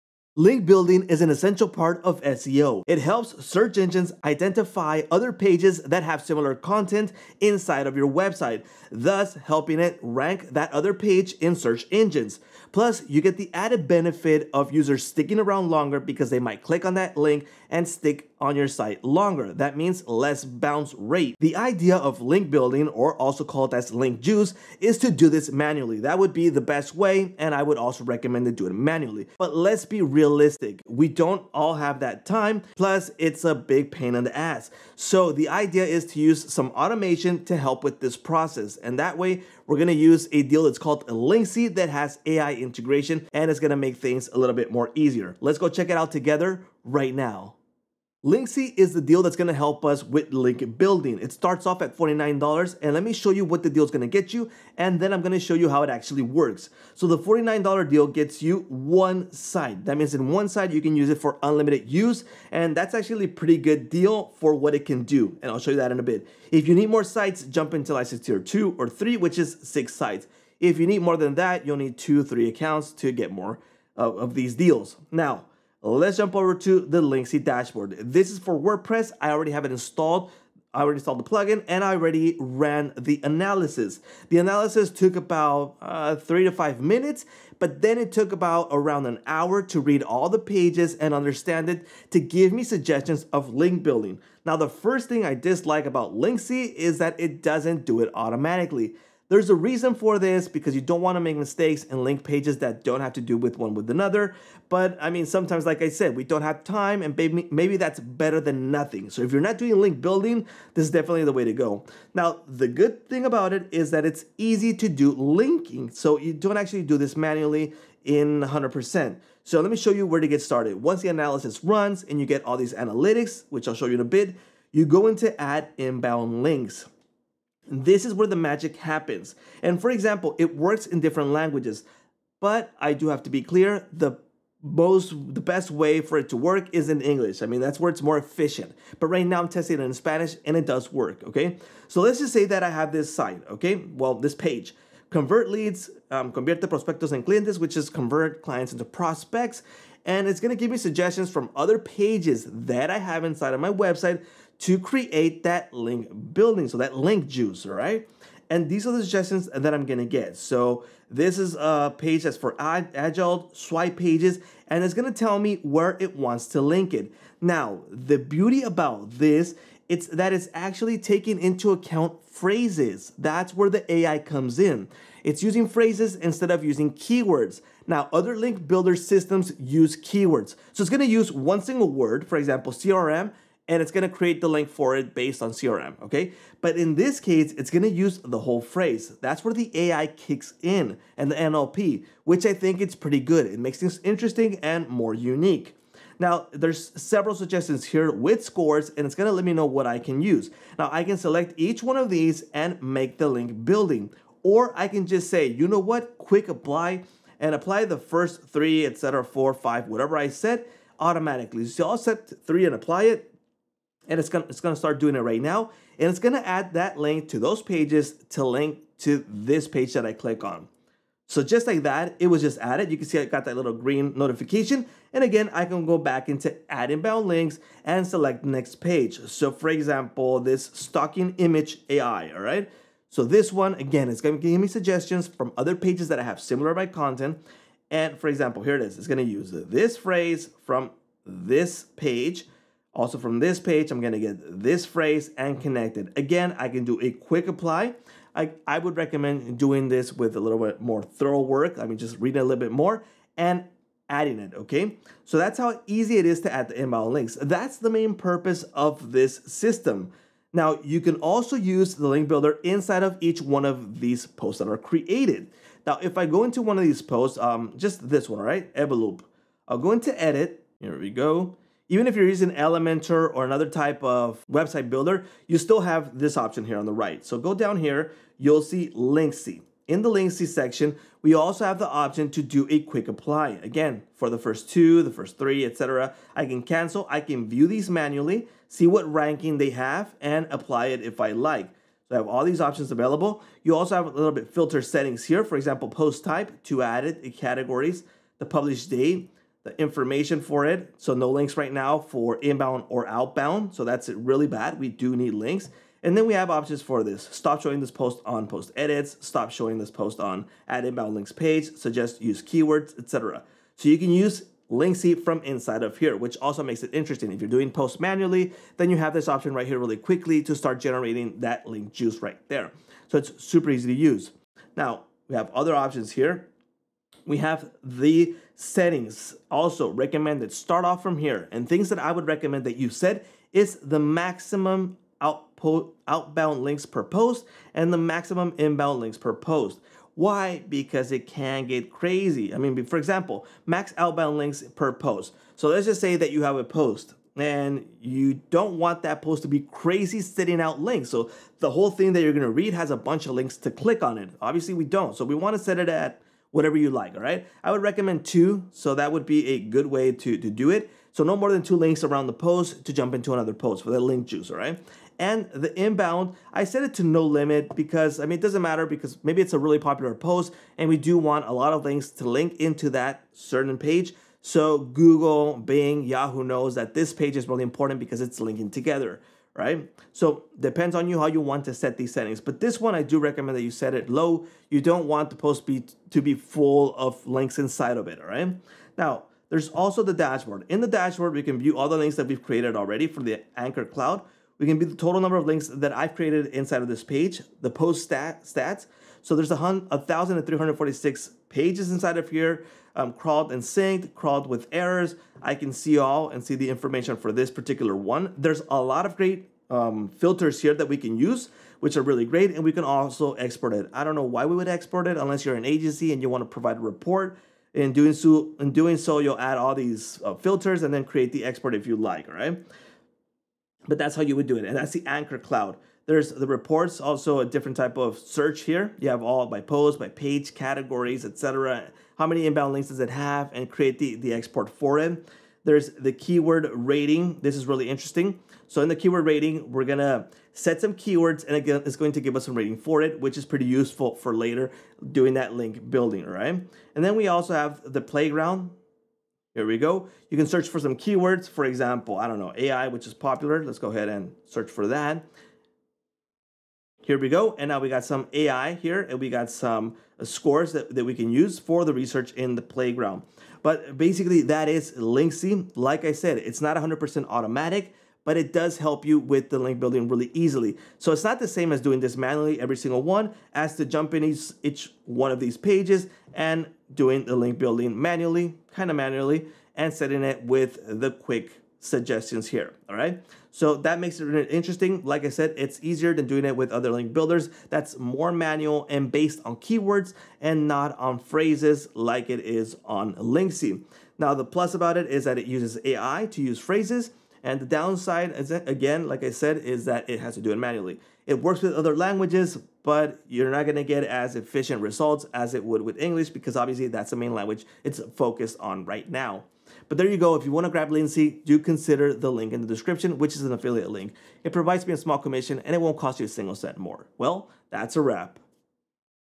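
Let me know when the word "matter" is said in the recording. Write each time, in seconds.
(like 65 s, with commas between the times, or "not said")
368 s.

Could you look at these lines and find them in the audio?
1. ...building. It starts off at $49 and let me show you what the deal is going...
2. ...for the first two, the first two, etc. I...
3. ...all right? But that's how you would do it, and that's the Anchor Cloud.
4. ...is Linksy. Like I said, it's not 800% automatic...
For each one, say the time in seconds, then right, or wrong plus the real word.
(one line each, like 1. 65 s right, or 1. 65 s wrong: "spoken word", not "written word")
1. 50 s right
2. 284 s wrong: "three", not "two"
3. 422 s right
4. 464 s wrong: "100", not "800".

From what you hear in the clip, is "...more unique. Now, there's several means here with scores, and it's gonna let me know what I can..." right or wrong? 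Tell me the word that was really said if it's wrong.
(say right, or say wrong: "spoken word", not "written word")
wrong: "suggestions", not "means".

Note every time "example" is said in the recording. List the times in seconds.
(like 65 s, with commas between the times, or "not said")
129 s, 182 s, 229 s, 238 s, 295 s, 342 s, 451 s.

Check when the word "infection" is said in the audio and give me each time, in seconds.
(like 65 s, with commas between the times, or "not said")
not said.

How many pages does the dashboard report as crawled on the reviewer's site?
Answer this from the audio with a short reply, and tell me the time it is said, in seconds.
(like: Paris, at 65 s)
1,346, at 399 s.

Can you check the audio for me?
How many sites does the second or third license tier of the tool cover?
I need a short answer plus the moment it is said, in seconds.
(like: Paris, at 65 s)
6, at 69 s.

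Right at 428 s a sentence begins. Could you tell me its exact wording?
You have all by post, by page, categories, etc.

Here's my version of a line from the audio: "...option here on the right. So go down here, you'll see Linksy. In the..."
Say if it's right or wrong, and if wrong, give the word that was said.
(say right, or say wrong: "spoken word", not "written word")
right.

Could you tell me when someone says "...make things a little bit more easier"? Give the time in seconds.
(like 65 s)
43 s.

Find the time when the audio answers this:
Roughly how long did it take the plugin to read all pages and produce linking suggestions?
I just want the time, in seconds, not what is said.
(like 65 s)
88 s.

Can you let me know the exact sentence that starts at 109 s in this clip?
So if you're not doing link building, this is definitely the way to go.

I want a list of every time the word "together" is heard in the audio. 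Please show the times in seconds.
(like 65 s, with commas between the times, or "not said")
46 s, 378 s.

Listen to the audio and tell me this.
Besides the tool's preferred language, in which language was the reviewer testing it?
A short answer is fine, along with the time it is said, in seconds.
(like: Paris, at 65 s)
Spanish, at 139 s.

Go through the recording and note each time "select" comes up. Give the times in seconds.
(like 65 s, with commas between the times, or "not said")
201 s, 228 s.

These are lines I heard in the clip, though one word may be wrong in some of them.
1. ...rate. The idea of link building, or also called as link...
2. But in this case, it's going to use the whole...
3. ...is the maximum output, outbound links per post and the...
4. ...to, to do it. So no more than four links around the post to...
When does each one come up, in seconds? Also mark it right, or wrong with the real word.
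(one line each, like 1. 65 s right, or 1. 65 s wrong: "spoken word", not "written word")
1. 20 s right
2. 186 s right
3. 333 s right
4. 360 s wrong: "two", not "four".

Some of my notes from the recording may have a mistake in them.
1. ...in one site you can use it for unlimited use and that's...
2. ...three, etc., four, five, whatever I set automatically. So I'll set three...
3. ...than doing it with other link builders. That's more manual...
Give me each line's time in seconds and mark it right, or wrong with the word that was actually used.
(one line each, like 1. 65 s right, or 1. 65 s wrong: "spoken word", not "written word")
1. 60 s right
2. 208 s right
3. 486 s right.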